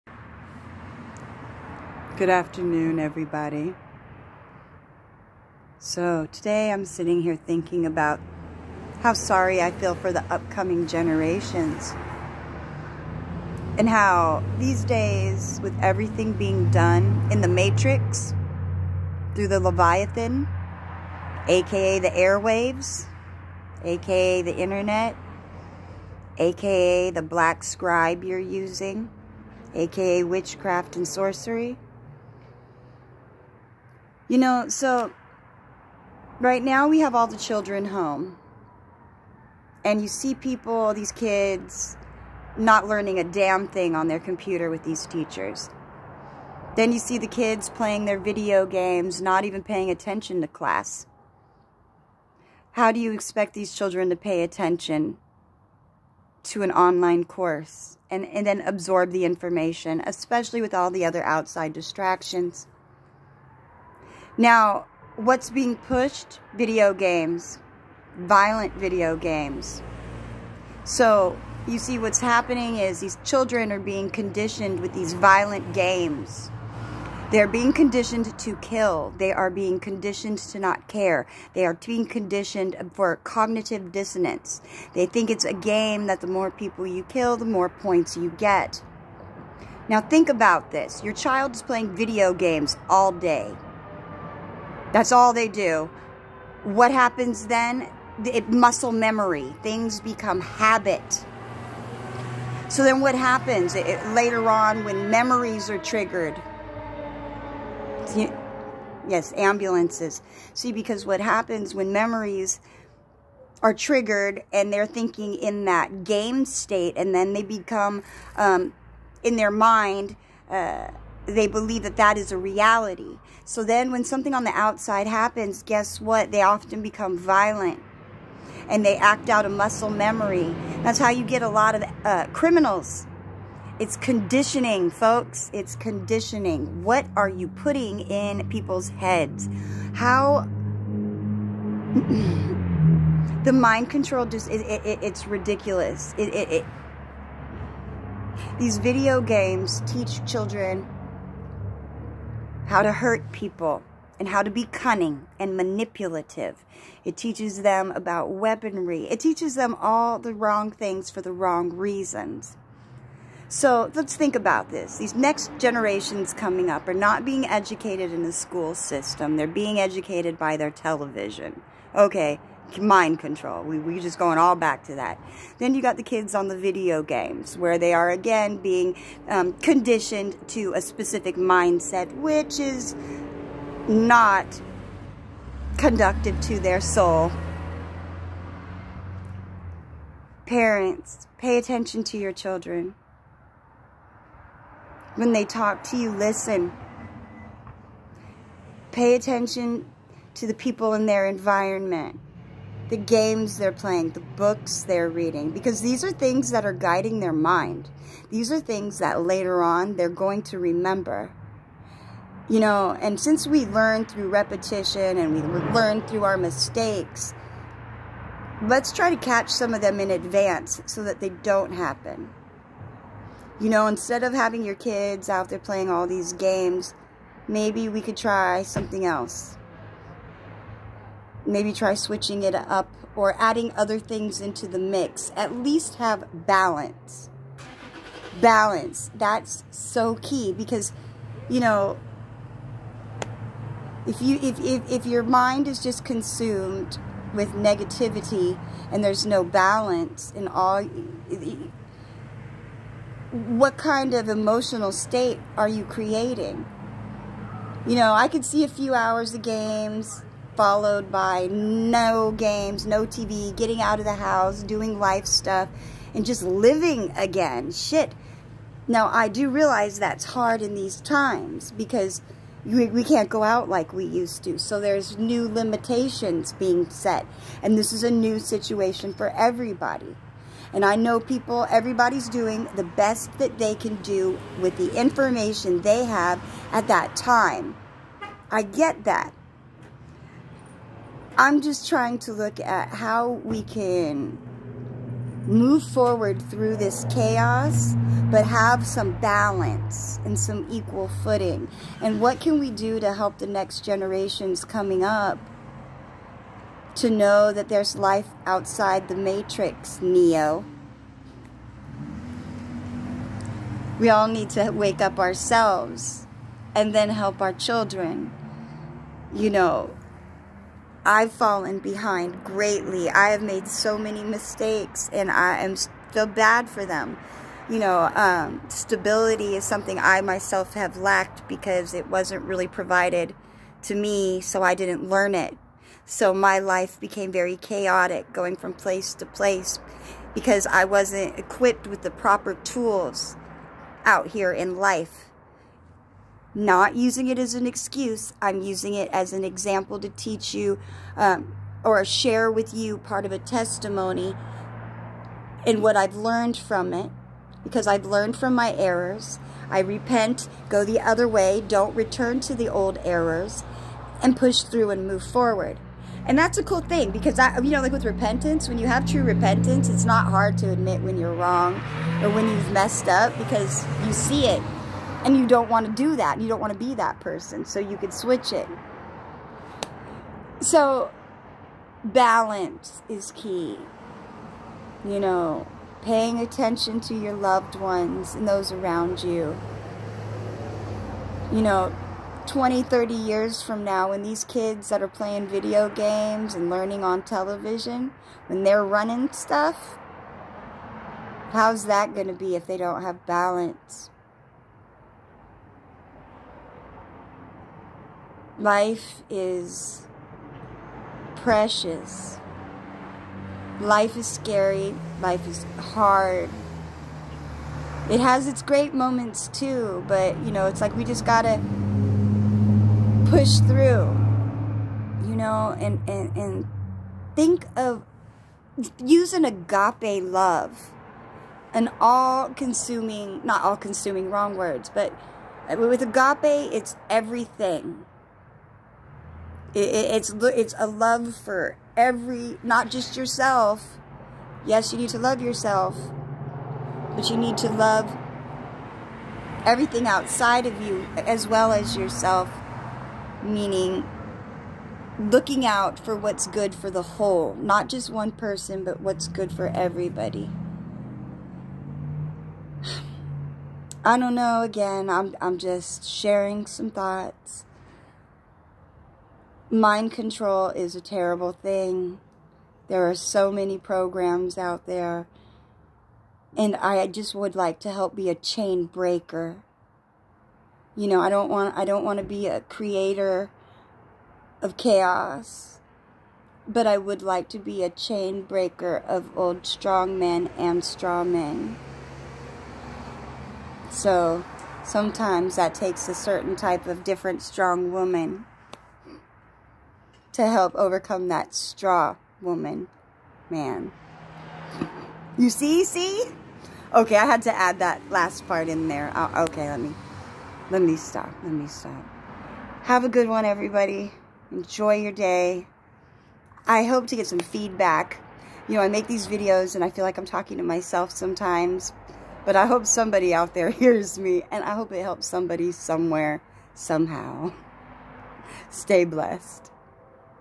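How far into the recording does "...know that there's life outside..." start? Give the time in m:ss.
5:07.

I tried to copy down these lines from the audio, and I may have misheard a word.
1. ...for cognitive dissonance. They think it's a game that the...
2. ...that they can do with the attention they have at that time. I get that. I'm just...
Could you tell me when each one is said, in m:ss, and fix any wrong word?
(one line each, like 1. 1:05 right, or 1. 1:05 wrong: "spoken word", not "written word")
1. 1:22 right
2. 4:43 wrong: "information", not "attention".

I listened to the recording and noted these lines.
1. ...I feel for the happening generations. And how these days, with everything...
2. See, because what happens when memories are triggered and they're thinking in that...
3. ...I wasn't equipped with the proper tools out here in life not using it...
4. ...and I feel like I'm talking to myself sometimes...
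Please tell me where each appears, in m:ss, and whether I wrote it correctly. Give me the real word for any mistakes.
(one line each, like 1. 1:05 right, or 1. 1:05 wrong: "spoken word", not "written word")
1. 0:09 wrong: "upcoming", not "happening"
2. 1:50 right
3. 5:40 right
4. 8:39 right.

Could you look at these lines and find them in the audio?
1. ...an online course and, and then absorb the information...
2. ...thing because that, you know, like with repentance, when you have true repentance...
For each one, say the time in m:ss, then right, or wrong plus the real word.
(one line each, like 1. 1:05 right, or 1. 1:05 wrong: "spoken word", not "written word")
1. 0:56 right
2. 6:06 right.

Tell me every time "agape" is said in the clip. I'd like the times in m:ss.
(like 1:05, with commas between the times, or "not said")
7:09, 7:16.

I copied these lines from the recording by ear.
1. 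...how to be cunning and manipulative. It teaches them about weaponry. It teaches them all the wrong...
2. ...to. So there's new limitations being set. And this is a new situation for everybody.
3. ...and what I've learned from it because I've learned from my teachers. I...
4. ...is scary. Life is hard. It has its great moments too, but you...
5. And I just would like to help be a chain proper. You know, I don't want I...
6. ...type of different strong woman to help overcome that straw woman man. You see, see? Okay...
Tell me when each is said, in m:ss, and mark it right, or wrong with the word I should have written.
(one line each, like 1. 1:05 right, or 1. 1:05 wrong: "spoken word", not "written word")
1. 2:34 right
2. 4:34 right
3. 5:55 wrong: "errors", not "teachers"
4. 6:54 right
5. 7:56 wrong: "breaker", not "proper"
6. 8:16 right.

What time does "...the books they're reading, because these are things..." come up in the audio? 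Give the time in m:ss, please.
3:24.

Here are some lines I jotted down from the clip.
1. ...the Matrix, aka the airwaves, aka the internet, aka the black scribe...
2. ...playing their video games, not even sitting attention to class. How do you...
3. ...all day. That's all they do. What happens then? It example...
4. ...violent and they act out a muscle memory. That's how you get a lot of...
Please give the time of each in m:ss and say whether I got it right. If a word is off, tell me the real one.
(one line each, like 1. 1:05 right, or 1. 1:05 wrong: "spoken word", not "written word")
1. 0:19 wrong: "Leviathan", not "Matrix"
2. 0:47 wrong: "paying", not "sitting"
3. 1:32 wrong: "muscle", not "example"
4. 2:07 right.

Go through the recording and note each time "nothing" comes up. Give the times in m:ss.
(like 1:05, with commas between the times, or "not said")
not said.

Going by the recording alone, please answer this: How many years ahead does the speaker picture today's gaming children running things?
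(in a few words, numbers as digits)
30.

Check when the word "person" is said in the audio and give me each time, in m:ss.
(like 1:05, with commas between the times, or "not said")
6:17, 7:38.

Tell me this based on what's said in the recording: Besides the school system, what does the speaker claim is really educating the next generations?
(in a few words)
their television.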